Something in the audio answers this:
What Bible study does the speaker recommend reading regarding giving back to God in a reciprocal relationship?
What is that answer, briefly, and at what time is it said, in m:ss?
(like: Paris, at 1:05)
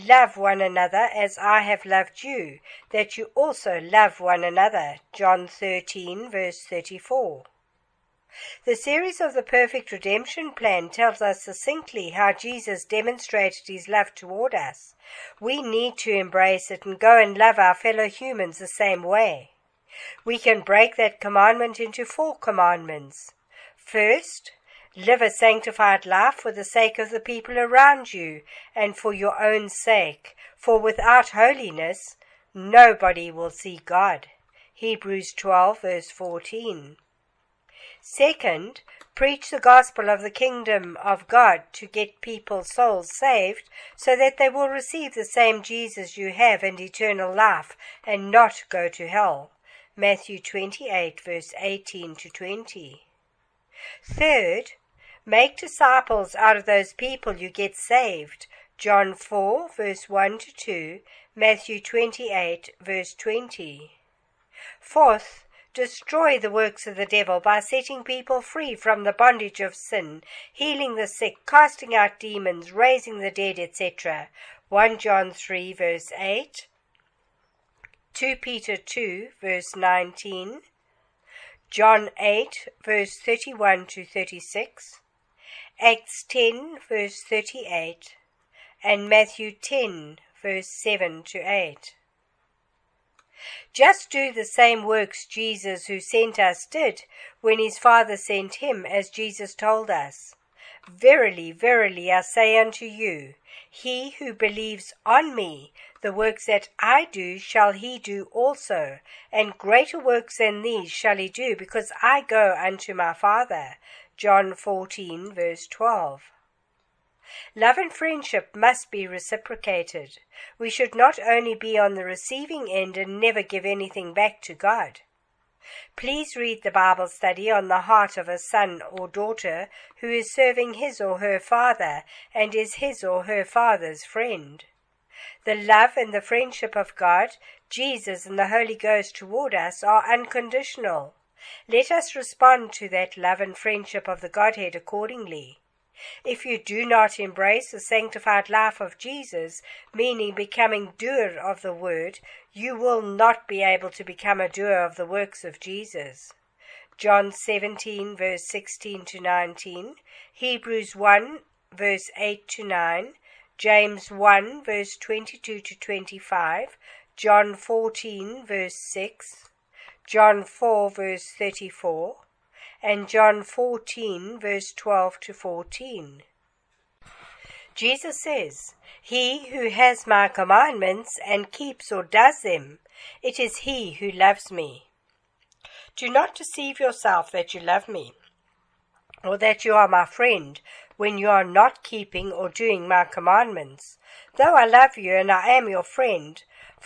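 The heart of a son or daughter, at 2:07.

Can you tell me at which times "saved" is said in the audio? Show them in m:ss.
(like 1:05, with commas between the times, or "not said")
0:43, 0:57.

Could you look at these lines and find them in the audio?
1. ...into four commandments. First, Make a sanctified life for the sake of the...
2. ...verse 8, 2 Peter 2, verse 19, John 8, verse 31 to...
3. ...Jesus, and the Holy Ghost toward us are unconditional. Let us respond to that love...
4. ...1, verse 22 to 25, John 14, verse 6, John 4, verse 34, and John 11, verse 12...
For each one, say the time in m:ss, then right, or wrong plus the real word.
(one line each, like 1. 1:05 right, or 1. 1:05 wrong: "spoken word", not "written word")
1. 0:21 wrong: "Live", not "Make"
2. 1:15 right
3. 2:17 right
4. 2:44 wrong: "14", not "11".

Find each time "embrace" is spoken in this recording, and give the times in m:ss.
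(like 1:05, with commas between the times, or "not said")
0:16, 2:27.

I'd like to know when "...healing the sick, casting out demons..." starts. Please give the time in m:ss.
1:10.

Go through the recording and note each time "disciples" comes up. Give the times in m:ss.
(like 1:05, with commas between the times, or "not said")
0:55.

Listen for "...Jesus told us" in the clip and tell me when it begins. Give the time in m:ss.
1:39.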